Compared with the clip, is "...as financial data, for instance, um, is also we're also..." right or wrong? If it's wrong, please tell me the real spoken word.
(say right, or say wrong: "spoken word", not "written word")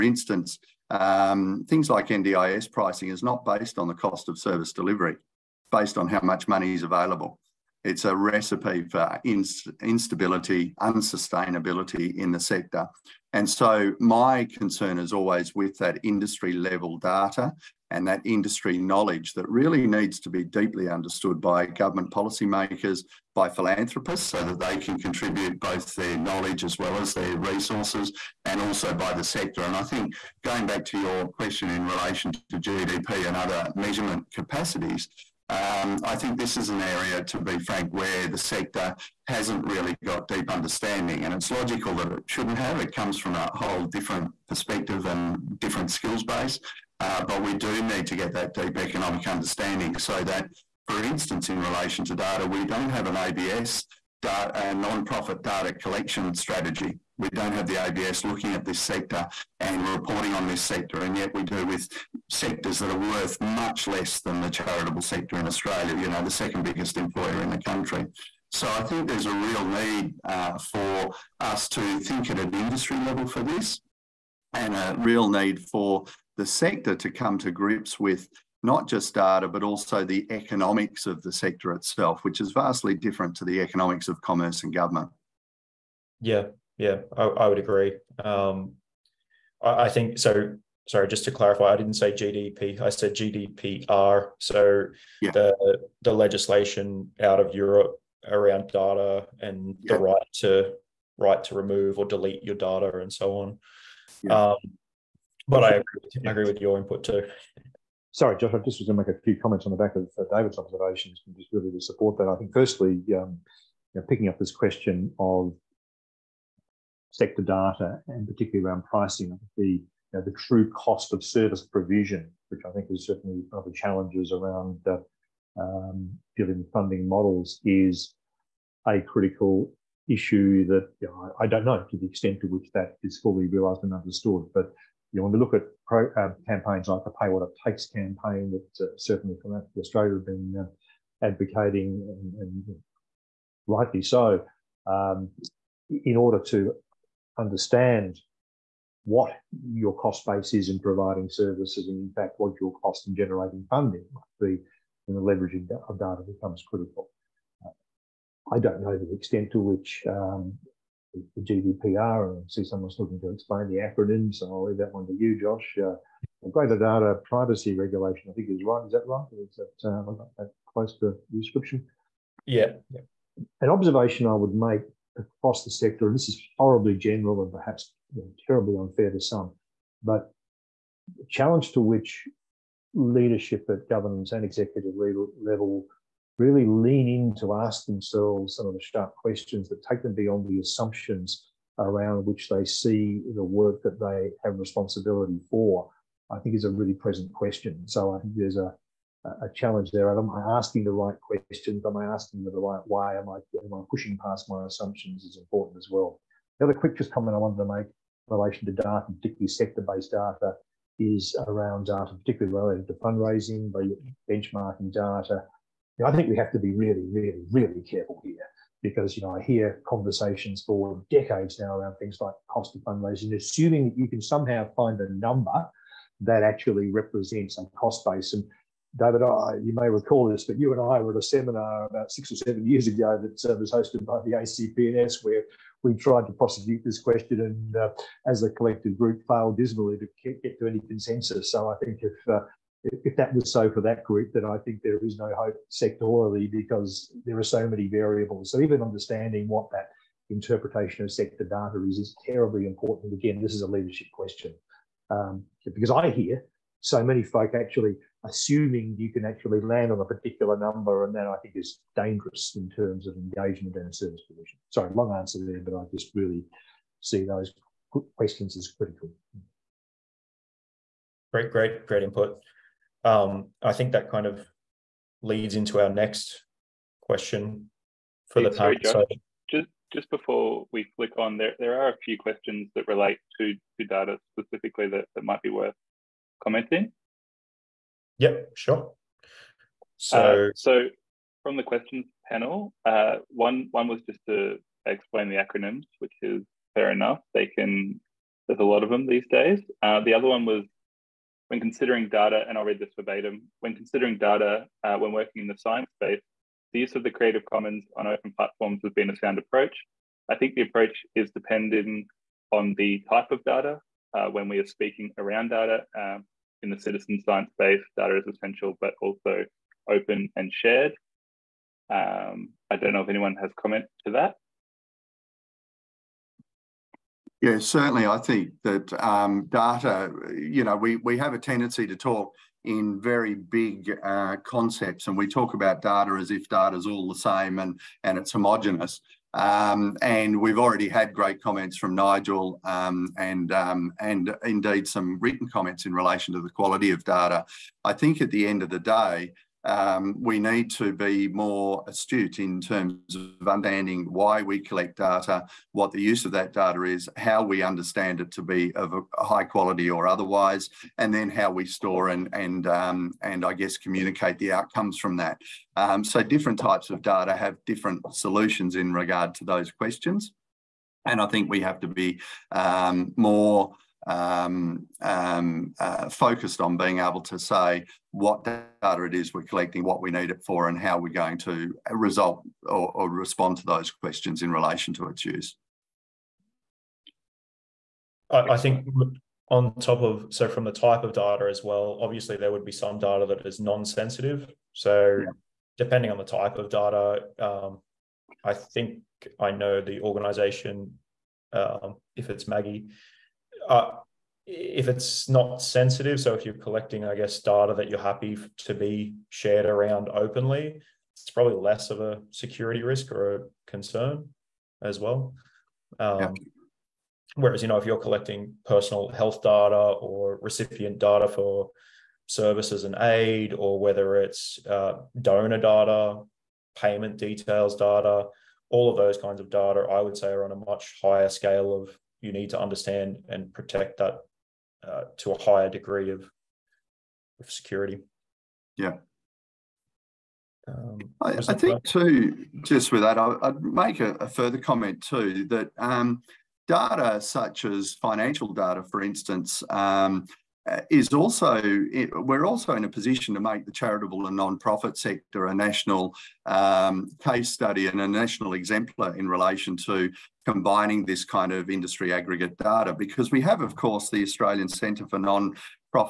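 right.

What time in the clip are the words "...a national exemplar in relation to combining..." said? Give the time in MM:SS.
07:38.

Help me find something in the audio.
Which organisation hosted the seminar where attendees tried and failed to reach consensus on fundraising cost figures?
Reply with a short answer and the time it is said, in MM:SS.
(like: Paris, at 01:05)
ACPNS, at 03:54.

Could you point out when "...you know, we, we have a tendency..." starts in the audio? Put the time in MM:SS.
05:30.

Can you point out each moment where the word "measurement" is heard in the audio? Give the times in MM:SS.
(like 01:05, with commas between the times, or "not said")
00:33.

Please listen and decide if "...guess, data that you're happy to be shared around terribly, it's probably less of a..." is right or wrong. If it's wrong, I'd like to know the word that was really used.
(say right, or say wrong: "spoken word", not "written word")
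wrong: "openly", not "terribly".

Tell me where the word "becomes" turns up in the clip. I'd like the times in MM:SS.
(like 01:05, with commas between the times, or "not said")
02:36.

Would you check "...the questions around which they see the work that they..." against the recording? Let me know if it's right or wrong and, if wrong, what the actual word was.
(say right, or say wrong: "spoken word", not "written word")
wrong: "assumptions", not "questions".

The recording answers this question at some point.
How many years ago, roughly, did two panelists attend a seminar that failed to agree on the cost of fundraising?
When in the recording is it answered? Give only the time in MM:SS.
03:52.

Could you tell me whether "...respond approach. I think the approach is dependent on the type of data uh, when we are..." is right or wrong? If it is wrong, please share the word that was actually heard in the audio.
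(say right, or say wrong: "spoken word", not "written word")
wrong: "sound", not "respond".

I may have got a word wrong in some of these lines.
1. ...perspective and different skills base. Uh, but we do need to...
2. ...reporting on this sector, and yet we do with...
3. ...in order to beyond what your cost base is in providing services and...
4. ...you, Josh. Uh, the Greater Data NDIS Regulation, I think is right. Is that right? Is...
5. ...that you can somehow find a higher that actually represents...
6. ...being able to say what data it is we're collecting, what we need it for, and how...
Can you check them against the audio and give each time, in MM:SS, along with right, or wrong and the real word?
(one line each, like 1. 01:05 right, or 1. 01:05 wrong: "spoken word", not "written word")
1. 00:44 right
2. 00:59 right
3. 02:26 wrong: "understand", not "beyond"
4. 02:45 wrong: "Privacy", not "NDIS"
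5. 03:43 wrong: "number", not "higher"
6. 06:16 right.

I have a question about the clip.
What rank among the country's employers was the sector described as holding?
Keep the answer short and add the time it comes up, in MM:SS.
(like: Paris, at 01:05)
second biggest, at 01:06.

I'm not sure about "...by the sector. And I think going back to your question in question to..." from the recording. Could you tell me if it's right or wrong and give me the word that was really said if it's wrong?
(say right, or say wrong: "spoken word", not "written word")
wrong: "relation", not "question".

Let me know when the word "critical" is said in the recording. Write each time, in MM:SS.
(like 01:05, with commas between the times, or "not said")
02:09, 02:36, 04:28.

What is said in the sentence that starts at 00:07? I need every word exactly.
It's a recipe for inst instability, unsustainability in the sector.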